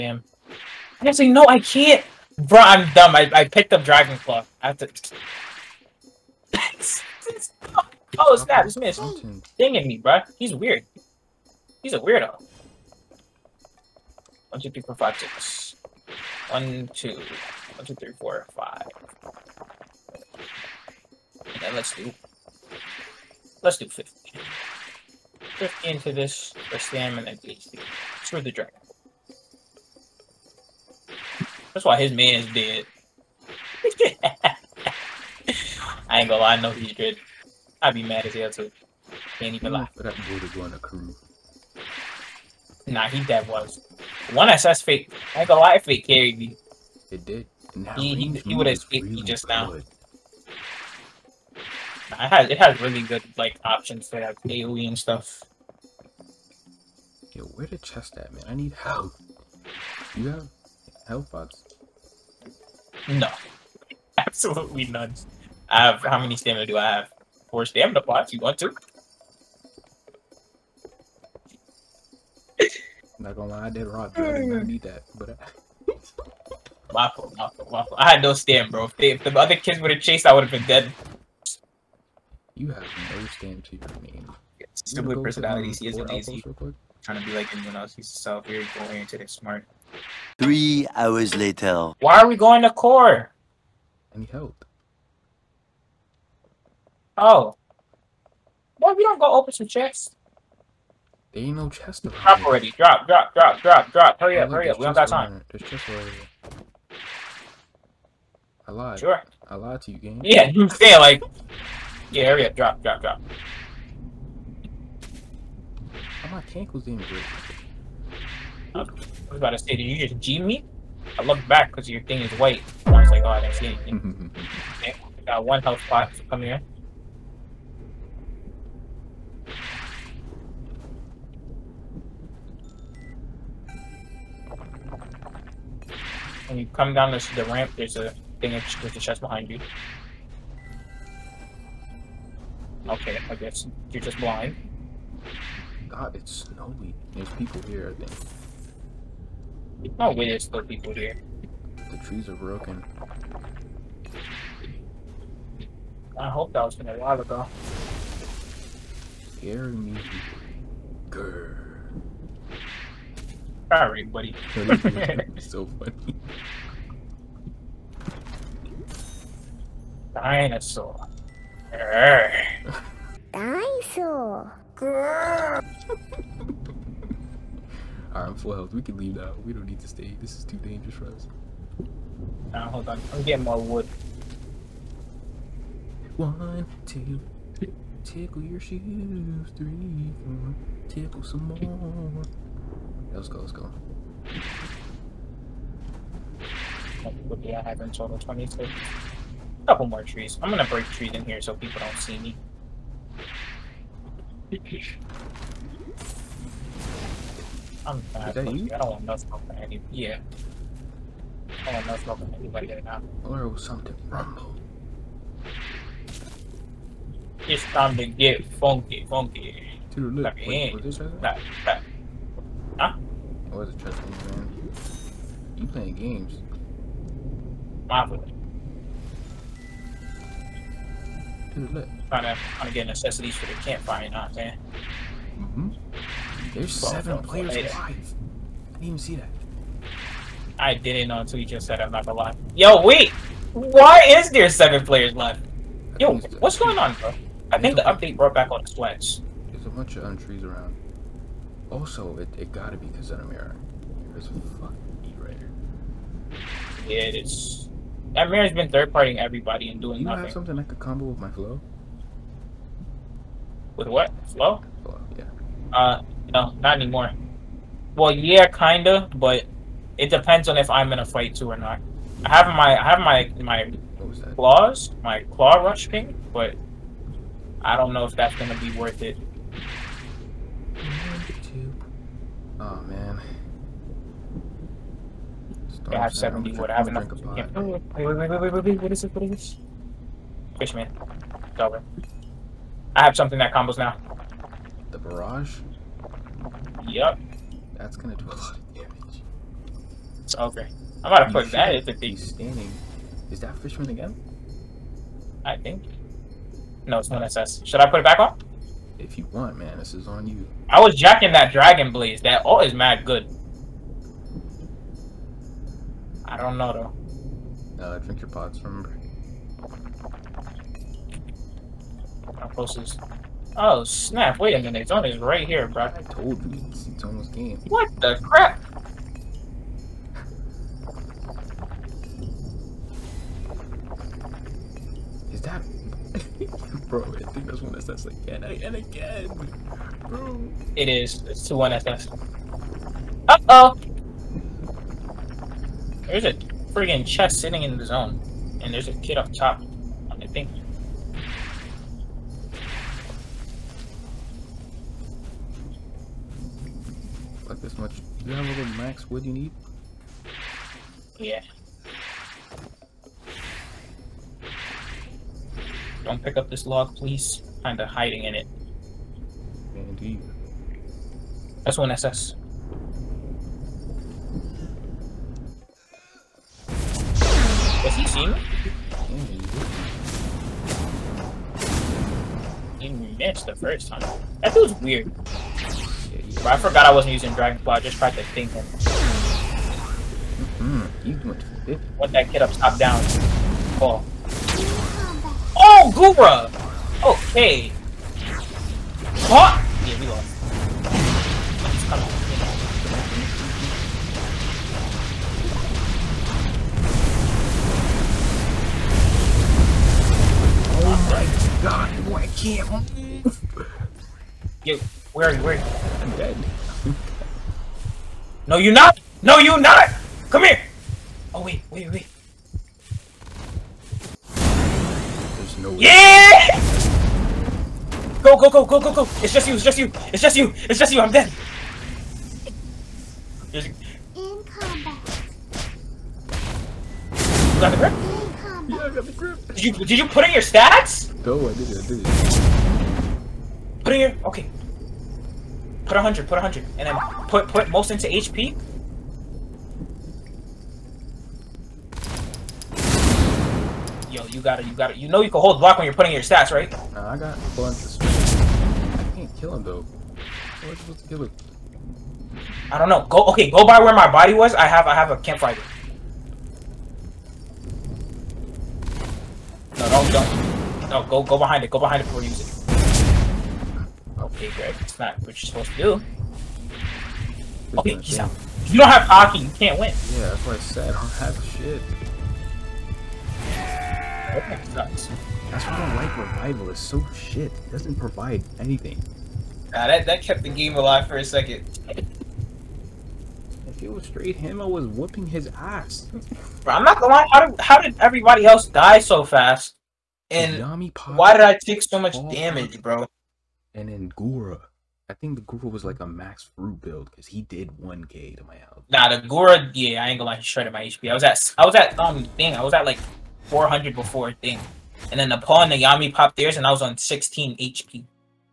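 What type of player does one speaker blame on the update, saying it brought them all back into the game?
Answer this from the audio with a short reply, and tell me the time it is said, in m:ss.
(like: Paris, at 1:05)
sweats, at 4:08.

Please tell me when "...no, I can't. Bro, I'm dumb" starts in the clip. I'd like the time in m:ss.
0:01.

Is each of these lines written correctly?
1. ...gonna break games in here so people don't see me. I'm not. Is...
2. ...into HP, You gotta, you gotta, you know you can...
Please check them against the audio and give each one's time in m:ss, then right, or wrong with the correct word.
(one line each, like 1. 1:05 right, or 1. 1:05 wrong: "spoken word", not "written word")
1. 3:20 wrong: "trees", not "games"
2. 7:27 right.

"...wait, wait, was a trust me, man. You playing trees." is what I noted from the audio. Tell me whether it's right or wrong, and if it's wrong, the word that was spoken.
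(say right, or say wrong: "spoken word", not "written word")
wrong: "games", not "trees".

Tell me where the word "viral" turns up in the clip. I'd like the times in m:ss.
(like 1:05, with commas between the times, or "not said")
not said.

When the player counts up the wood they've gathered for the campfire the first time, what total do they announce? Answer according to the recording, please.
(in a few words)
22.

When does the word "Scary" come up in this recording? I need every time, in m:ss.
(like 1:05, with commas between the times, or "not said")
2:39.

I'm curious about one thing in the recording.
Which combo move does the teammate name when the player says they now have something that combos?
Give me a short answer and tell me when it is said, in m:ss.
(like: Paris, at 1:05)
The barrage, at 4:54.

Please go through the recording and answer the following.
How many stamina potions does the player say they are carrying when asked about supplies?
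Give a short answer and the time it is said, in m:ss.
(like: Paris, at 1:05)
4, at 1:07.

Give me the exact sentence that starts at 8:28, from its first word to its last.
Nah, the Gura, yeah, I ain't gonna lie, he shredded my HP.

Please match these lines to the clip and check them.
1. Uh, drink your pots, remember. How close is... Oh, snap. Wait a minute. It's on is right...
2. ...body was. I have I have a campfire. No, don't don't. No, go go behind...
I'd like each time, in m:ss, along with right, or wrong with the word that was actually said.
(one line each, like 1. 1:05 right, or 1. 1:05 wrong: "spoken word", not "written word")
1. 5:17 right
2. 7:44 right.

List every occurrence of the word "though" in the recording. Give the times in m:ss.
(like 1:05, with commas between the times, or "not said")
5:17, 7:39.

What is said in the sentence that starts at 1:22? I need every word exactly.
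You have no stand to your name.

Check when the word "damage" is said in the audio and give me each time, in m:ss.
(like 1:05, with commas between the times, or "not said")
4:58, 8:22.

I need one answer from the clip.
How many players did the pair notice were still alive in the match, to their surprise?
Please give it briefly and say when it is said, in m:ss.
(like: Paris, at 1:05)
7, at 3:56.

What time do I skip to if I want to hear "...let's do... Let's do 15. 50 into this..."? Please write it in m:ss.
0:21.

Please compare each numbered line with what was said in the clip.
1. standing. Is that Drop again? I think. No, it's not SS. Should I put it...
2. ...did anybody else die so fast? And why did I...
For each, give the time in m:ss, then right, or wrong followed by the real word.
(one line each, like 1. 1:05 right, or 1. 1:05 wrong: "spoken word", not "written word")
1. 5:02 wrong: "Fishman", not "Drop"
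2. 8:17 wrong: "everybody", not "anybody".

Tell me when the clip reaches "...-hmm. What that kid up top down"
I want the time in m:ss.
6:30.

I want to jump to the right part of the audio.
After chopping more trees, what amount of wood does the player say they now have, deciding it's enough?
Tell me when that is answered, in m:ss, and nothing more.
4:45.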